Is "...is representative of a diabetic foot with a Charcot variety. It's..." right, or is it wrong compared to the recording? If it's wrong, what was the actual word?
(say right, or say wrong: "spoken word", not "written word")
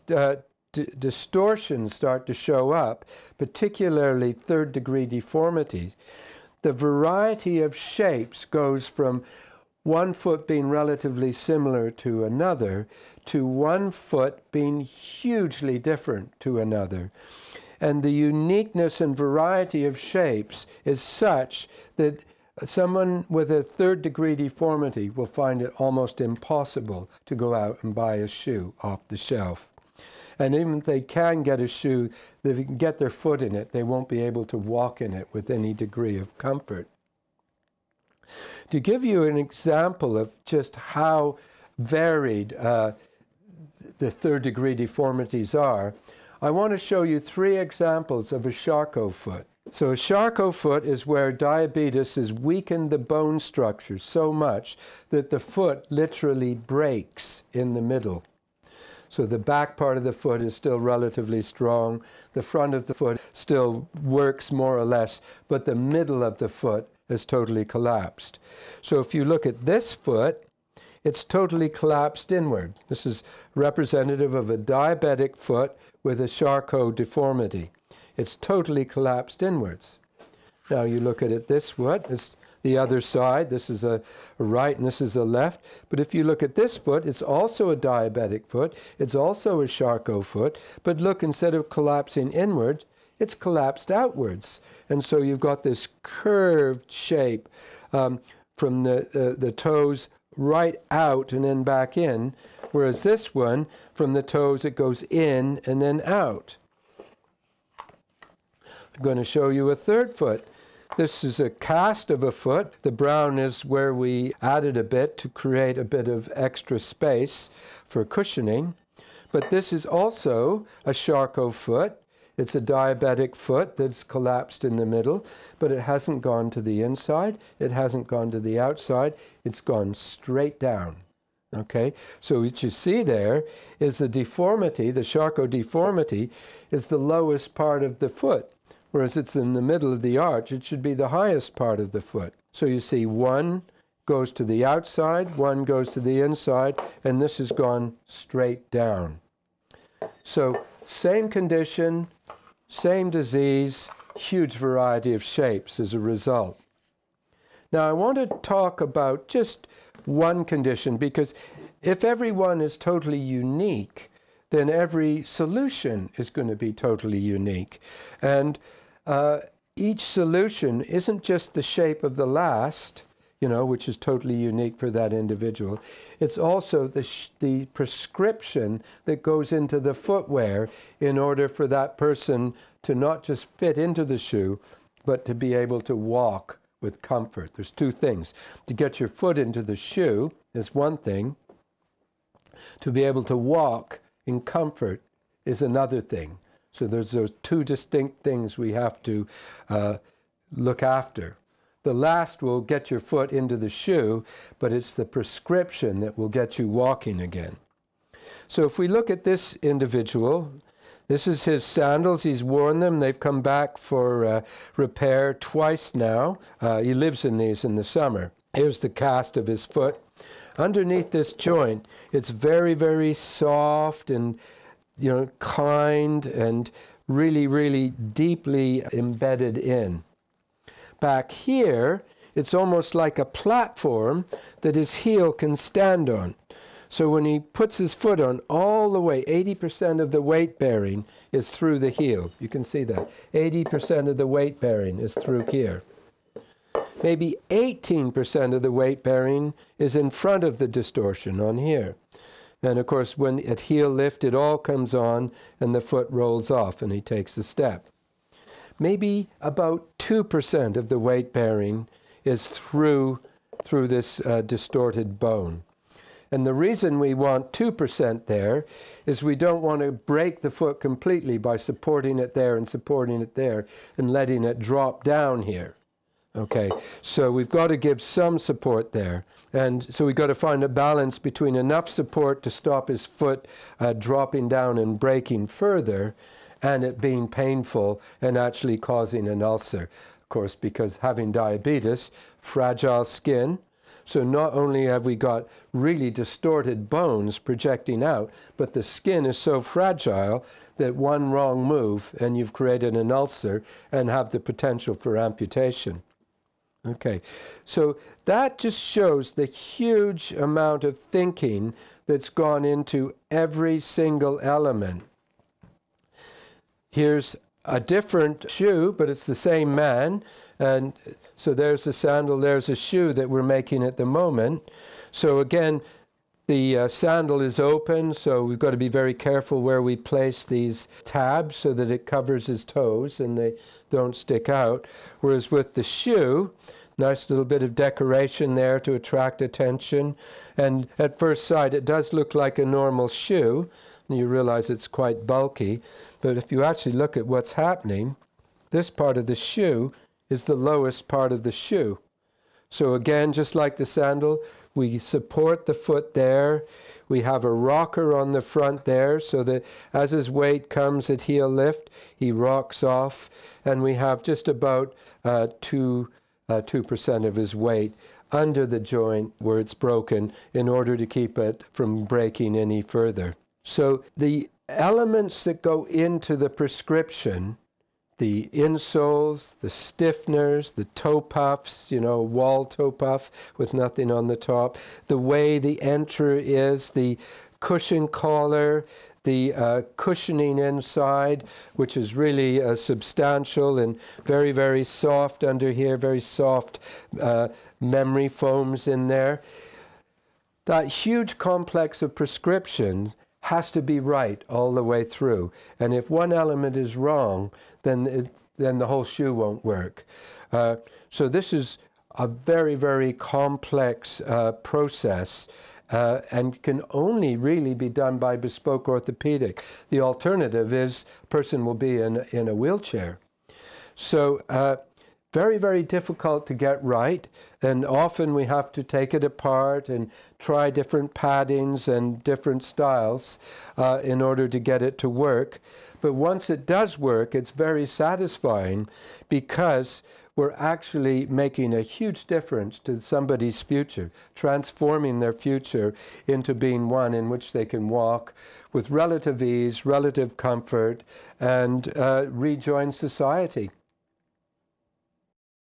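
wrong: "deformity", not "variety".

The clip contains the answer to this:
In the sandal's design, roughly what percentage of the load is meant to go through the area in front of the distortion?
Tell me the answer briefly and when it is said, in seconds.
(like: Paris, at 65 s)
18%, at 247 s.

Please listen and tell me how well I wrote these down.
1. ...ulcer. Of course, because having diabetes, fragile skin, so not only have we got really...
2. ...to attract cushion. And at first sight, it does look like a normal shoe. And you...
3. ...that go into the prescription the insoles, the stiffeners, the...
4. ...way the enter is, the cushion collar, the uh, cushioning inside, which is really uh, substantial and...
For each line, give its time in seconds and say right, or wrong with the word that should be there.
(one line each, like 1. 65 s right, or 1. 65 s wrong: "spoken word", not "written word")
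1. 289 s right
2. 338 s wrong: "attention", not "cushion"
3. 375 s right
4. 385 s right.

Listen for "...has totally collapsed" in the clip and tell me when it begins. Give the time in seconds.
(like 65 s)
67 s.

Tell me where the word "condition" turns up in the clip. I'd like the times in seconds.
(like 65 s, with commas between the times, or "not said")
151 s, 160 s.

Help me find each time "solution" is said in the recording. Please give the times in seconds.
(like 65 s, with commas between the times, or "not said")
165 s, 170 s.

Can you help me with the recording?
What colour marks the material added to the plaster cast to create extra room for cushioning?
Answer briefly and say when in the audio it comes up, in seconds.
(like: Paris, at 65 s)
Brown, at 112 s.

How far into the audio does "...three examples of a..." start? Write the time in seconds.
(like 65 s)
47 s.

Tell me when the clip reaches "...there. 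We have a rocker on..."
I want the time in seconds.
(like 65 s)
356 s.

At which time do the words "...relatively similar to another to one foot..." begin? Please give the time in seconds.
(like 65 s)
10 s.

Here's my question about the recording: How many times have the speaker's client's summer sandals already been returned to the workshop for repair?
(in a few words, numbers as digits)
2.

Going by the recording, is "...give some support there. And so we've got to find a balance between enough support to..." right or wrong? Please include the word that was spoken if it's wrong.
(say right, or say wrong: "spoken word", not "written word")
right.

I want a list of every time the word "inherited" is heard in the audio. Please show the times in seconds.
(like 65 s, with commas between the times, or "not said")
not said.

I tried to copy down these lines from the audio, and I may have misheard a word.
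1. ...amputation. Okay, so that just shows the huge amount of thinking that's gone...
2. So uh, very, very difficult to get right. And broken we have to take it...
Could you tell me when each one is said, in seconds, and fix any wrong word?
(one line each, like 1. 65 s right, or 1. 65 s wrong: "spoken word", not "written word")
1. 305 s right
2. 423 s wrong: "often", not "broken".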